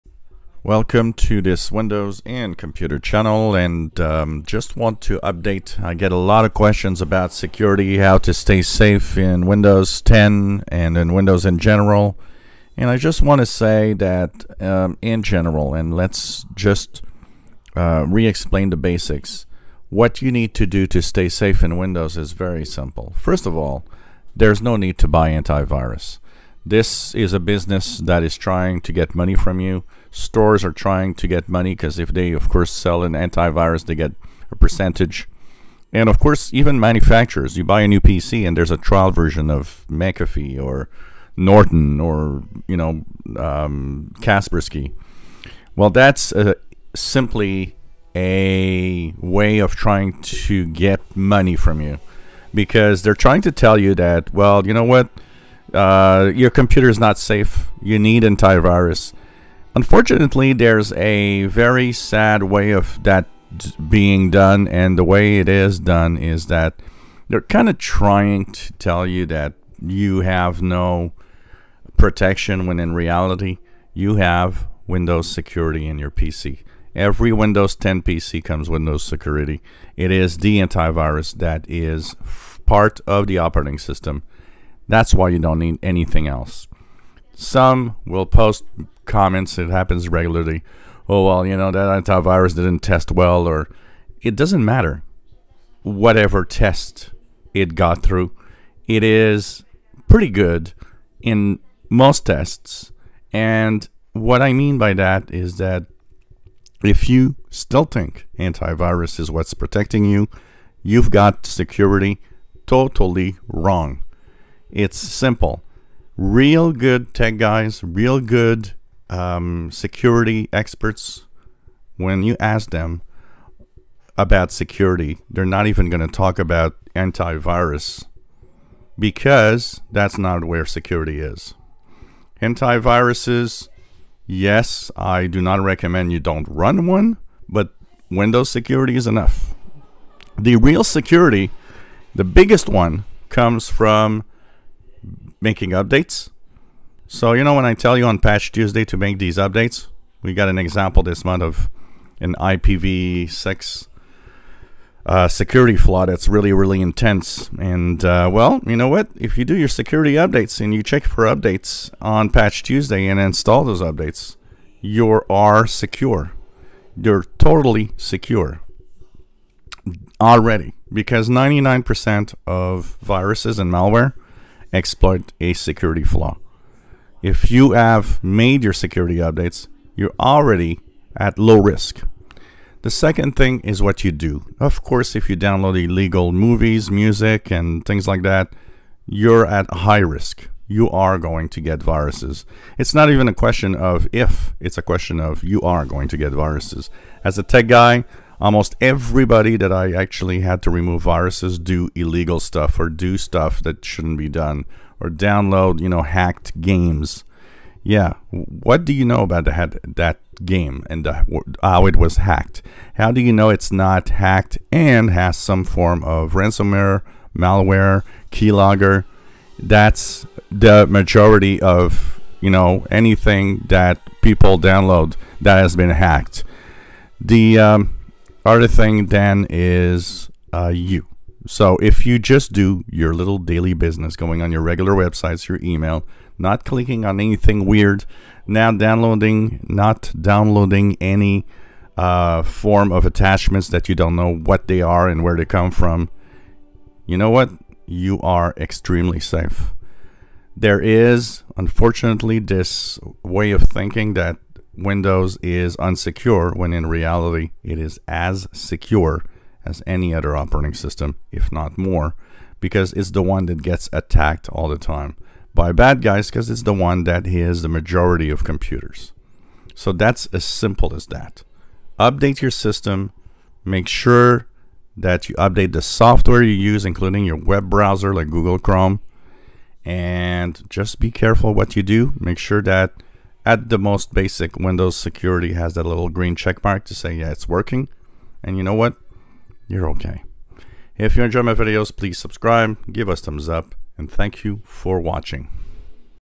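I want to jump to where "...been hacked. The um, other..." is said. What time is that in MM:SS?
03:45.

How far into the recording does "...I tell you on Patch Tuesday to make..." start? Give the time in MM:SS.
02:27.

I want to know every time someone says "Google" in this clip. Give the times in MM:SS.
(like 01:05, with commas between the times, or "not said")
04:38.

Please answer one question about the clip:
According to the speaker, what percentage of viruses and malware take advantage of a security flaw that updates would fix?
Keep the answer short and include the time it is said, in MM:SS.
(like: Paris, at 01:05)
99%, at 02:51.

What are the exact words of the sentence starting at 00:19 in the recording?
What you need to do to stay safe in Windows is very simple.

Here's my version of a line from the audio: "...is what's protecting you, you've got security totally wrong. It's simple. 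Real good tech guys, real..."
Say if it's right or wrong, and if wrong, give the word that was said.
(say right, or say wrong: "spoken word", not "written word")
right.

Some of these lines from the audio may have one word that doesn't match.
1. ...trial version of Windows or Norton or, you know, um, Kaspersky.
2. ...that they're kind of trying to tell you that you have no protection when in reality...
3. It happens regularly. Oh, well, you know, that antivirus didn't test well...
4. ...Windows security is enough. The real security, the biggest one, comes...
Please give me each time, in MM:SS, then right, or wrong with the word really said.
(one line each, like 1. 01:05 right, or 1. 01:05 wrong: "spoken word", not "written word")
1. 00:38 wrong: "McAfee", not "Windows"
2. 01:06 right
3. 01:29 right
4. 02:18 right.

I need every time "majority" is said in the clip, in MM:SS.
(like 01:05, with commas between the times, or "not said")
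03:40, 04:27.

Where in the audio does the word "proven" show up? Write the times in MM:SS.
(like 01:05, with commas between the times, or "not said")
not said.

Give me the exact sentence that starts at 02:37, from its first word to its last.
And uh, well, you know what?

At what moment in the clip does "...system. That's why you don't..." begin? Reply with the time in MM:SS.
01:23.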